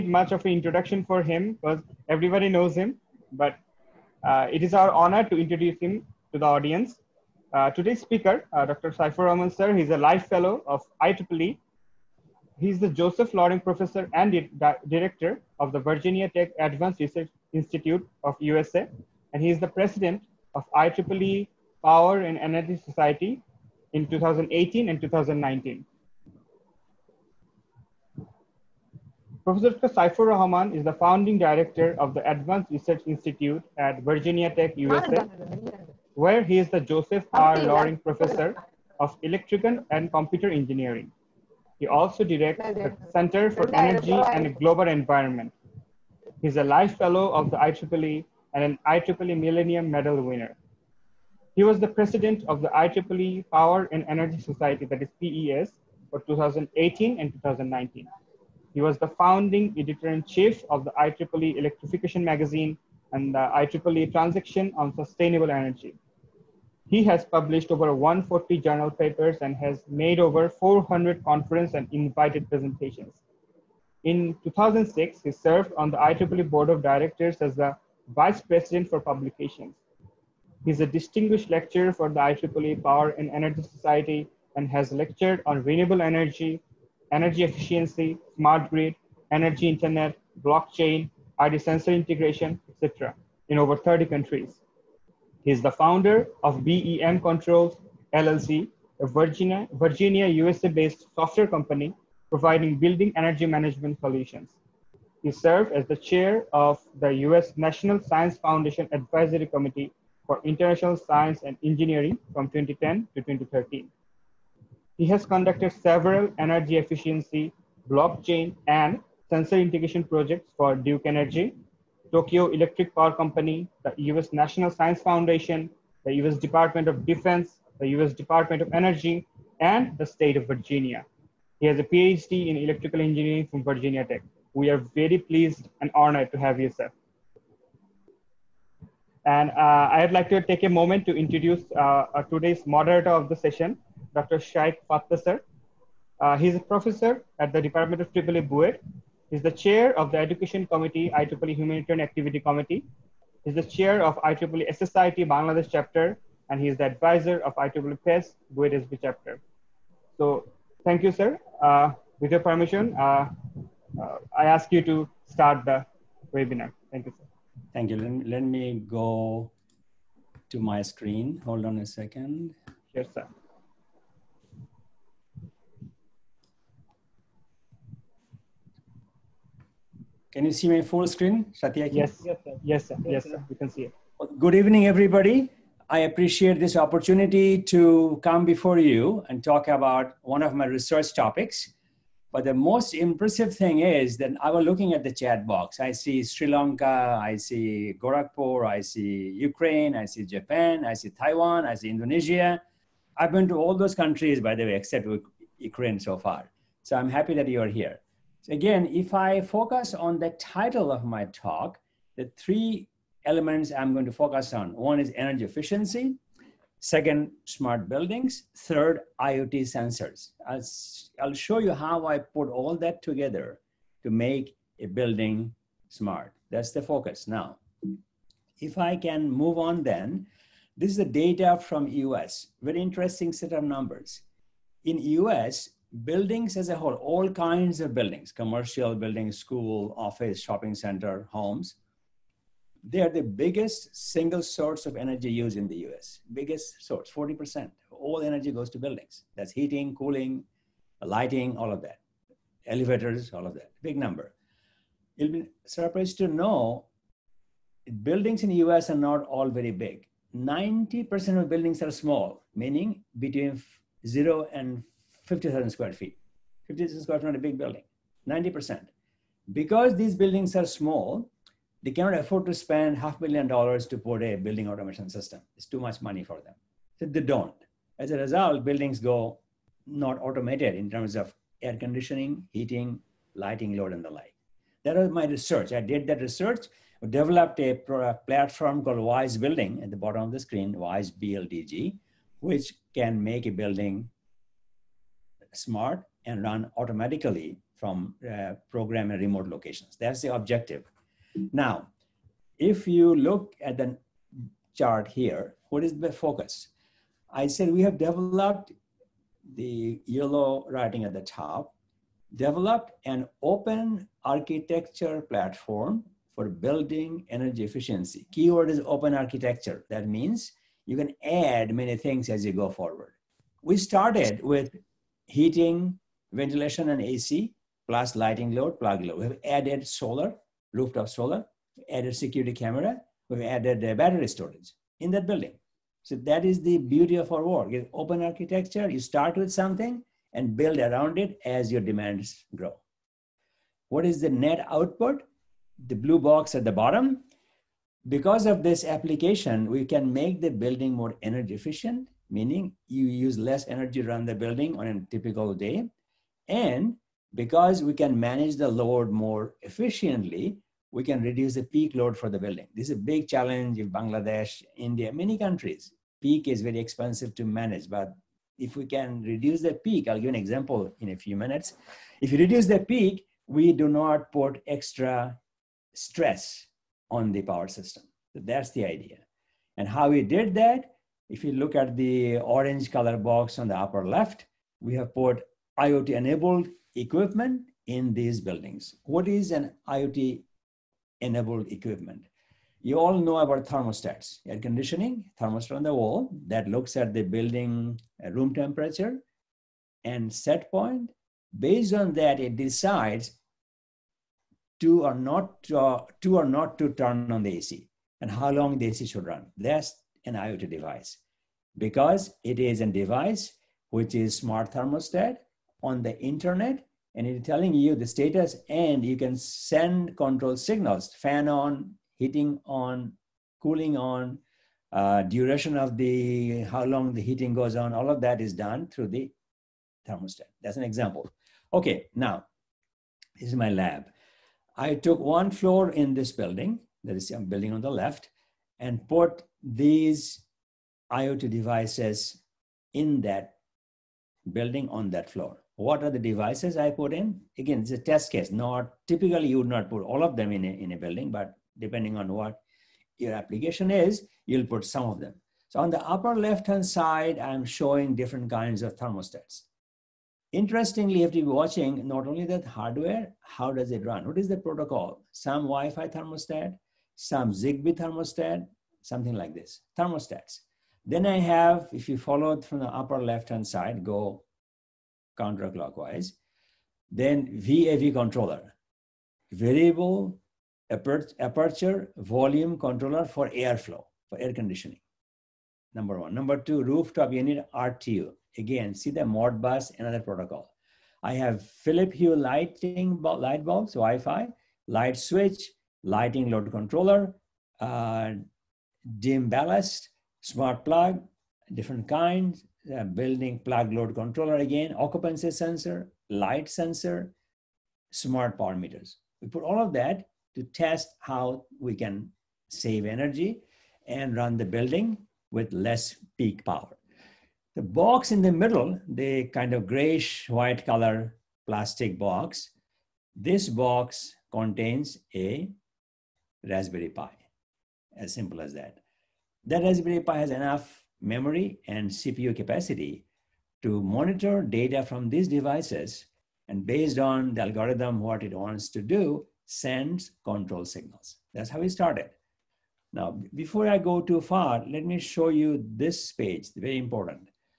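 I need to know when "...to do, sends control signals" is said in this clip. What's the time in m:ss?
8:58.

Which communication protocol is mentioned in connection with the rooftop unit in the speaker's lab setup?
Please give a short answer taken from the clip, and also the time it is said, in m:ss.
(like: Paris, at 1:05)
Modbus, at 8:09.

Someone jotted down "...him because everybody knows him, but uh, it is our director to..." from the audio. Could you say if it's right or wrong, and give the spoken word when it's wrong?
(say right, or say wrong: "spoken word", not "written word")
wrong: "honor", not "director".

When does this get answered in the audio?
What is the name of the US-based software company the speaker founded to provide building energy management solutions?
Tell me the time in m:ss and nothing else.
1:36.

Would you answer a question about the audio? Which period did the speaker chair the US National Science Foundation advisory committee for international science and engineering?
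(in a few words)
2010 to 2013.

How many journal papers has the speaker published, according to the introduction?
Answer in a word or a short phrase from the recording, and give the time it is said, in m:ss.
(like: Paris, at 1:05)
over 140, at 1:07.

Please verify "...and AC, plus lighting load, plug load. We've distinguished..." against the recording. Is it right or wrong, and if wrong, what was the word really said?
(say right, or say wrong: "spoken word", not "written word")
wrong: "added", not "distinguished".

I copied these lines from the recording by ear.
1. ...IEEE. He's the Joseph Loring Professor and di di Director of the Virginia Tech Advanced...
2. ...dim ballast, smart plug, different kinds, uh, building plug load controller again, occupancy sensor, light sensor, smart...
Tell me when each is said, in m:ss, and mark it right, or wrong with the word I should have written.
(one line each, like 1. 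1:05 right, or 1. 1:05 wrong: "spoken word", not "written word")
1. 0:11 right
2. 8:19 right.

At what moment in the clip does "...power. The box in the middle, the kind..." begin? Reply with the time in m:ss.
8:36.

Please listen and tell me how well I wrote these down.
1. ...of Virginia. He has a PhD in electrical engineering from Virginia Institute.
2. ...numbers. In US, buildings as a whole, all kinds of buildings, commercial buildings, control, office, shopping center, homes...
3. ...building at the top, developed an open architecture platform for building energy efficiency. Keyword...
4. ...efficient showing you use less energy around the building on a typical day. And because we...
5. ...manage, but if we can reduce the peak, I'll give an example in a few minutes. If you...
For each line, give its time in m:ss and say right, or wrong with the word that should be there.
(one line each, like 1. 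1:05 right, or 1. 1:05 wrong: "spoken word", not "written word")
1. 2:10 wrong: "Tech", not "Institute"
2. 3:53 wrong: "school", not "control"
3. 5:10 wrong: "writing", not "building"
4. 5:51 wrong: "meaning", not "showing"
5. 6:07 right.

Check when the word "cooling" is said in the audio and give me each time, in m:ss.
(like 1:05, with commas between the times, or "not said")
4:09, 7:03.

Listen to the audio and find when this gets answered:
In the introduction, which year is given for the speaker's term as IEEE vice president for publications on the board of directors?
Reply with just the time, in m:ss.
1:14.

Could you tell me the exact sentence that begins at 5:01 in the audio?
Now, if you look at the chart here, what is the focus?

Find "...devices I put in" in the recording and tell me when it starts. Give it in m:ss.
7:26.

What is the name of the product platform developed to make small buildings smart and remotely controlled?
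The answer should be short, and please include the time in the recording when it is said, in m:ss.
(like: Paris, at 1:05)
Wise Building, at 4:48.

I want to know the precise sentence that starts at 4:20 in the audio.
90% of buildings are small, meaning between 0 and 50,000 square feet.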